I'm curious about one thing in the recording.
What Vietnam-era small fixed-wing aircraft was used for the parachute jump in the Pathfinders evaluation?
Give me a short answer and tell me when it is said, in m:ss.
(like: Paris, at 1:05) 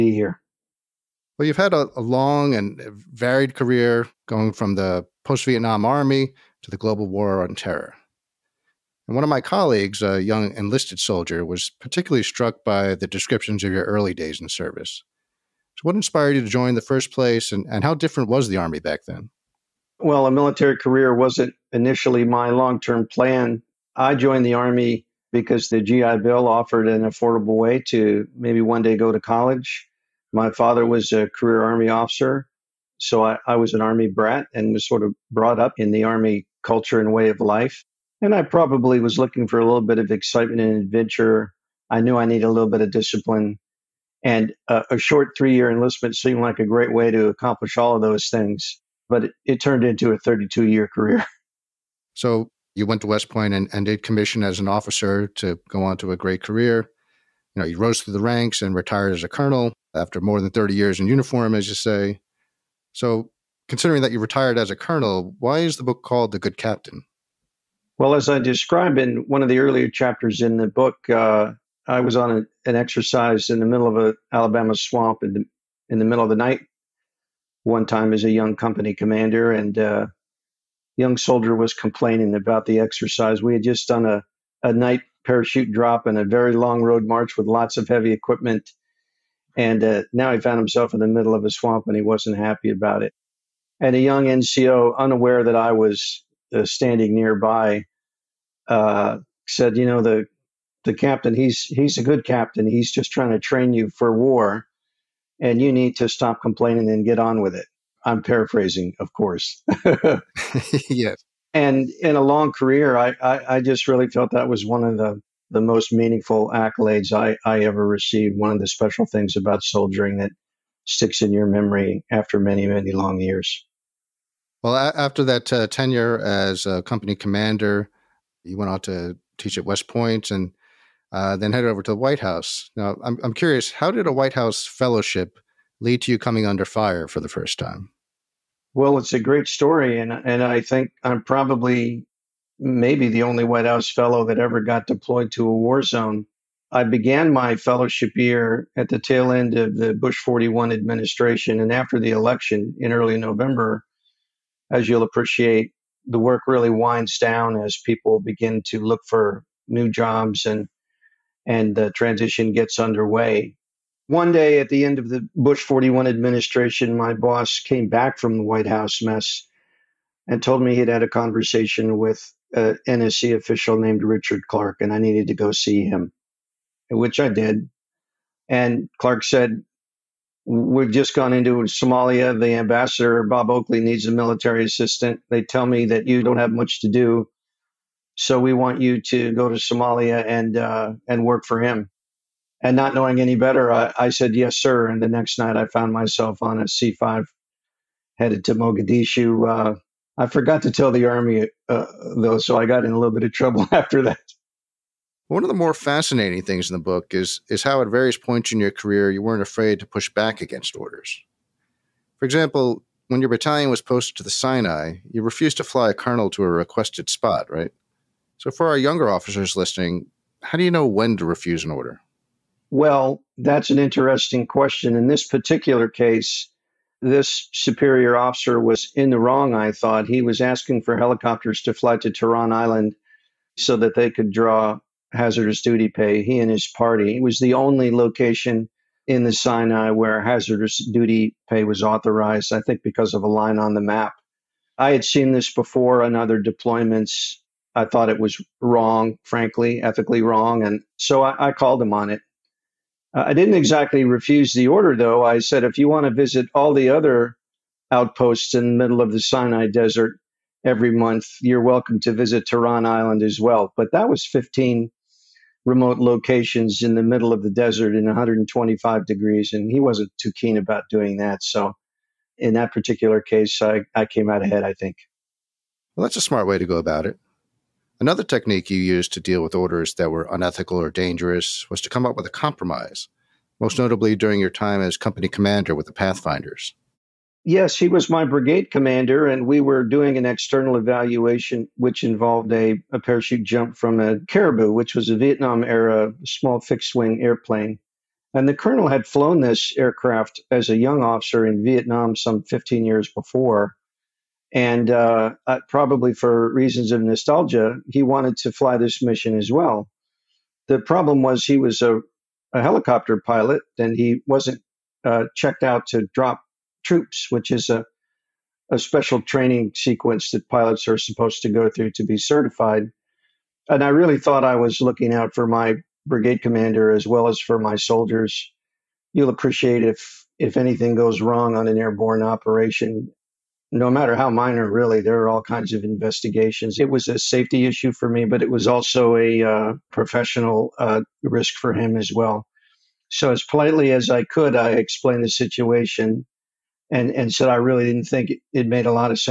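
Caribou, at 4:54.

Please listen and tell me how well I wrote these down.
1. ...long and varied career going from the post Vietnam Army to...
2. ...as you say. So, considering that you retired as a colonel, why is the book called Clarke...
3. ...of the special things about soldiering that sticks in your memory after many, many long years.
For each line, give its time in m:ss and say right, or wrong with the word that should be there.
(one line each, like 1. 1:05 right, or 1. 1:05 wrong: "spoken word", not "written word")
1. 0:02 right
2. 1:01 wrong: "The", not "Clarke"
3. 1:58 right.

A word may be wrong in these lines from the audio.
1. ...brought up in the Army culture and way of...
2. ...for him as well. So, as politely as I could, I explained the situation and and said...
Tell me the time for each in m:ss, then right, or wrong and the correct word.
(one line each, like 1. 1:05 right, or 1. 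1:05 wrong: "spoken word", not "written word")
1. 0:35 right
2. 5:41 right.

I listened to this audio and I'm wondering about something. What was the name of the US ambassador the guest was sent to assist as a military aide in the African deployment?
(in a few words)
Bob Oakley.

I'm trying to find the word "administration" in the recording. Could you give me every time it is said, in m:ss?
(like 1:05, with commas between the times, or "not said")
2:30, 2:46.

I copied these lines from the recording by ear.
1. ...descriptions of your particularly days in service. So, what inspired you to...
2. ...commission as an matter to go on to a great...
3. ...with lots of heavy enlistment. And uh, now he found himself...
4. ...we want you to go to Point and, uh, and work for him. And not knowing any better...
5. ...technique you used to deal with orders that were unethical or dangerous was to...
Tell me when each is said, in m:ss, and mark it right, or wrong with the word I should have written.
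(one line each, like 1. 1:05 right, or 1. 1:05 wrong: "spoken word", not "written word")
1. 0:13 wrong: "early", not "particularly"
2. 0:54 wrong: "officer", not "matter"
3. 1:27 wrong: "equipment", not "enlistment"
4. 3:08 wrong: "Somalia", not "Point"
5. 4:38 right.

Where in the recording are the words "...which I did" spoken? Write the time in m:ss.
2:56.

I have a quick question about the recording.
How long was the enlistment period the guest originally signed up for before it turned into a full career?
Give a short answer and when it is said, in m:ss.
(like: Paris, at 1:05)
3 years, at 0:45.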